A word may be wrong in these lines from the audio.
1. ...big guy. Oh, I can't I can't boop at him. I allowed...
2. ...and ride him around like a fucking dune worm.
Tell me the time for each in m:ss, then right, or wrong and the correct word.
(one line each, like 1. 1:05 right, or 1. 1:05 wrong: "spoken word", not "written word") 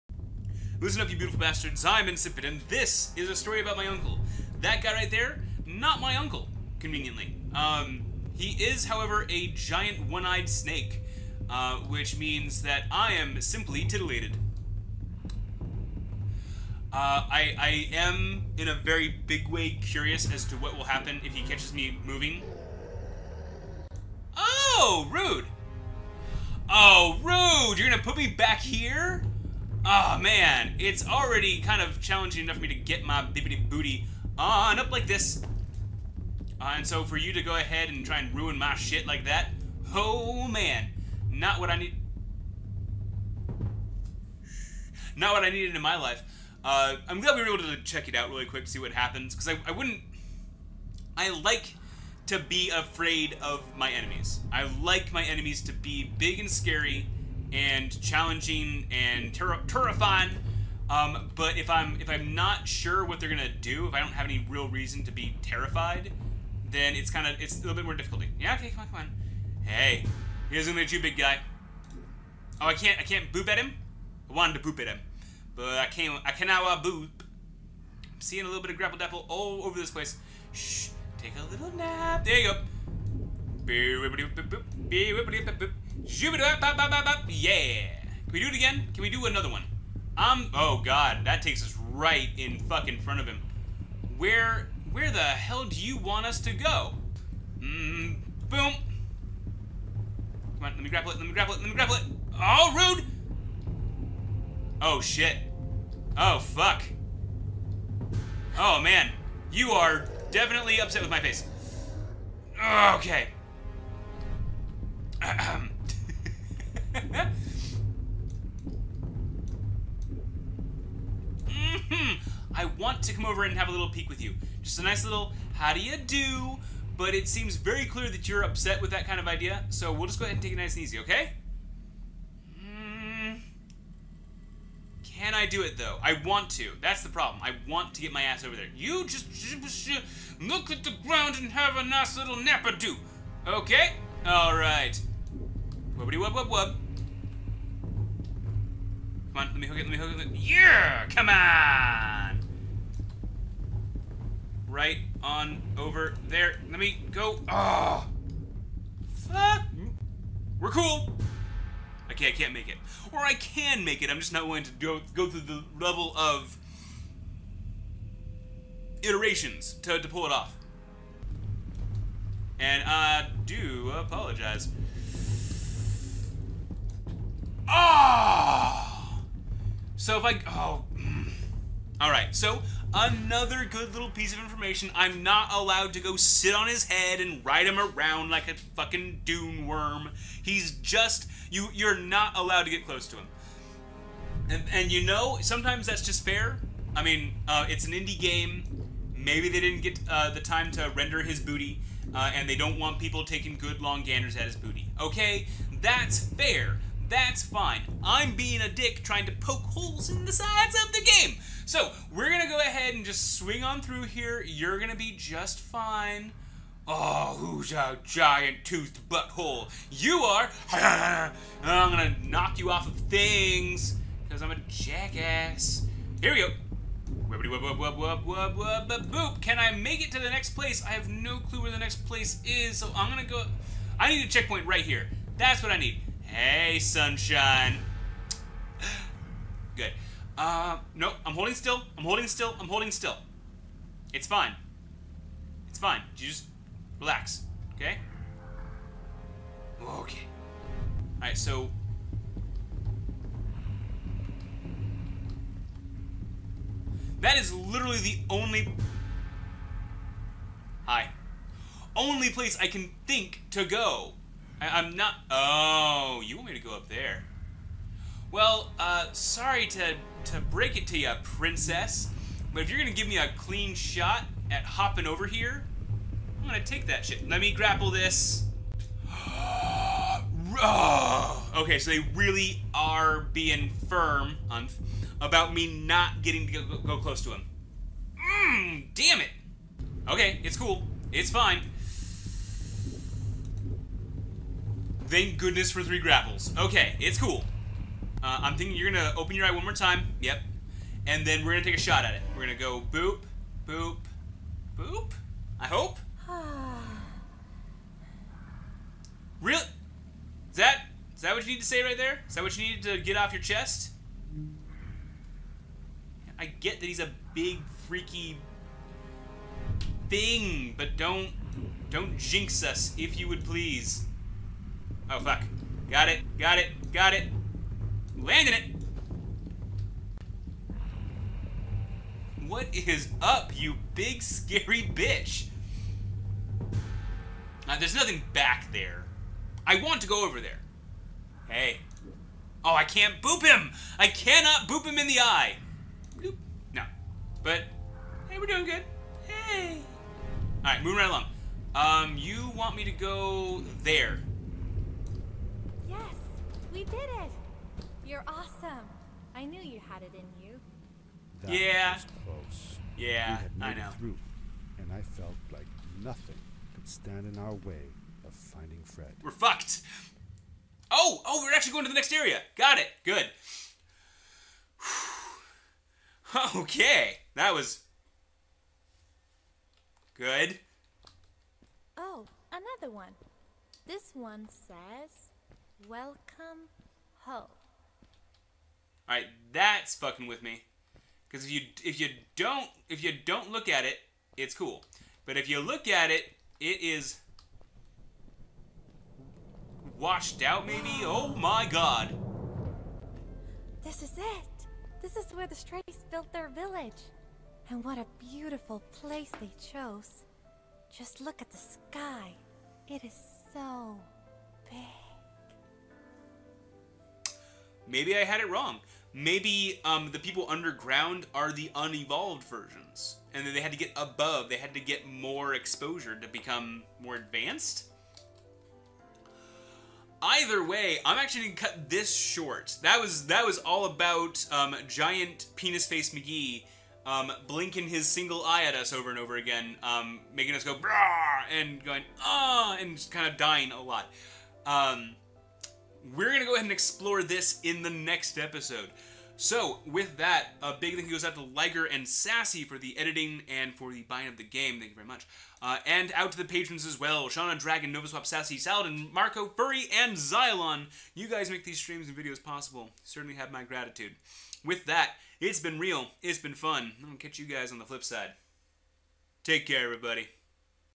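1. 1:11 wrong: "wanted", not "allowed"
2. 3:07 right.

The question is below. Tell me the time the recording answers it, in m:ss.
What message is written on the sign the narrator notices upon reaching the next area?
6:25.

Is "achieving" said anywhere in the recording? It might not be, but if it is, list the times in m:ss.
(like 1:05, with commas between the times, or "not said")
not said.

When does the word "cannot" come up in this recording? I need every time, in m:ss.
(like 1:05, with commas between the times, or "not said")
1:16, 5:44.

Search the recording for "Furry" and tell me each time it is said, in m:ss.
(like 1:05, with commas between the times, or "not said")
7:39.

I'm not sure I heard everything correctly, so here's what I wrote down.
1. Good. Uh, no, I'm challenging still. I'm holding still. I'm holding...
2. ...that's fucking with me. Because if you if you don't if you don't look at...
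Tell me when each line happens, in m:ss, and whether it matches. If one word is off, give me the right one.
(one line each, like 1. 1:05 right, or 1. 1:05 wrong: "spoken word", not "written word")
1. 3:59 wrong: "holding", not "challenging"
2. 6:29 right.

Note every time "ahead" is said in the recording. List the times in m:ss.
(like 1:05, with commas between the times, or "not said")
0:37, 2:10, 3:32, 7:26.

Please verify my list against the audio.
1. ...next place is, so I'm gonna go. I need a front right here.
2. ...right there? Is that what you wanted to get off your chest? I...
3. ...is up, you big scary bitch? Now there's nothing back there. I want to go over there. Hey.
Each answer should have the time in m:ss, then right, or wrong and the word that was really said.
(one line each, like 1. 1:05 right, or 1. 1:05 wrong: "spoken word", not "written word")
1. 3:51 wrong: "checkpoint", not "front"
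2. 5:11 wrong: "needed", not "wanted"
3. 5:32 right.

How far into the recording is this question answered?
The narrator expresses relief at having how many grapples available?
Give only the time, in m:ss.
4:55.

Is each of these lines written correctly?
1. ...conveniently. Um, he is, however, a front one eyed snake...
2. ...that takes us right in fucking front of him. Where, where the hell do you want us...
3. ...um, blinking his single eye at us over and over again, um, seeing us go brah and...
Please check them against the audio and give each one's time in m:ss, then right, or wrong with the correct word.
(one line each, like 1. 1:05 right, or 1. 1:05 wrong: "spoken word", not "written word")
1. 0:06 wrong: "giant", not "front"
2. 1:31 right
3. 7:17 wrong: "making", not "seeing".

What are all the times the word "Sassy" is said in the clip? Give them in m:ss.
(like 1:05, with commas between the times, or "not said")
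7:32, 7:38.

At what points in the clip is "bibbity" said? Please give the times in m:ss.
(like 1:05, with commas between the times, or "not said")
0:33.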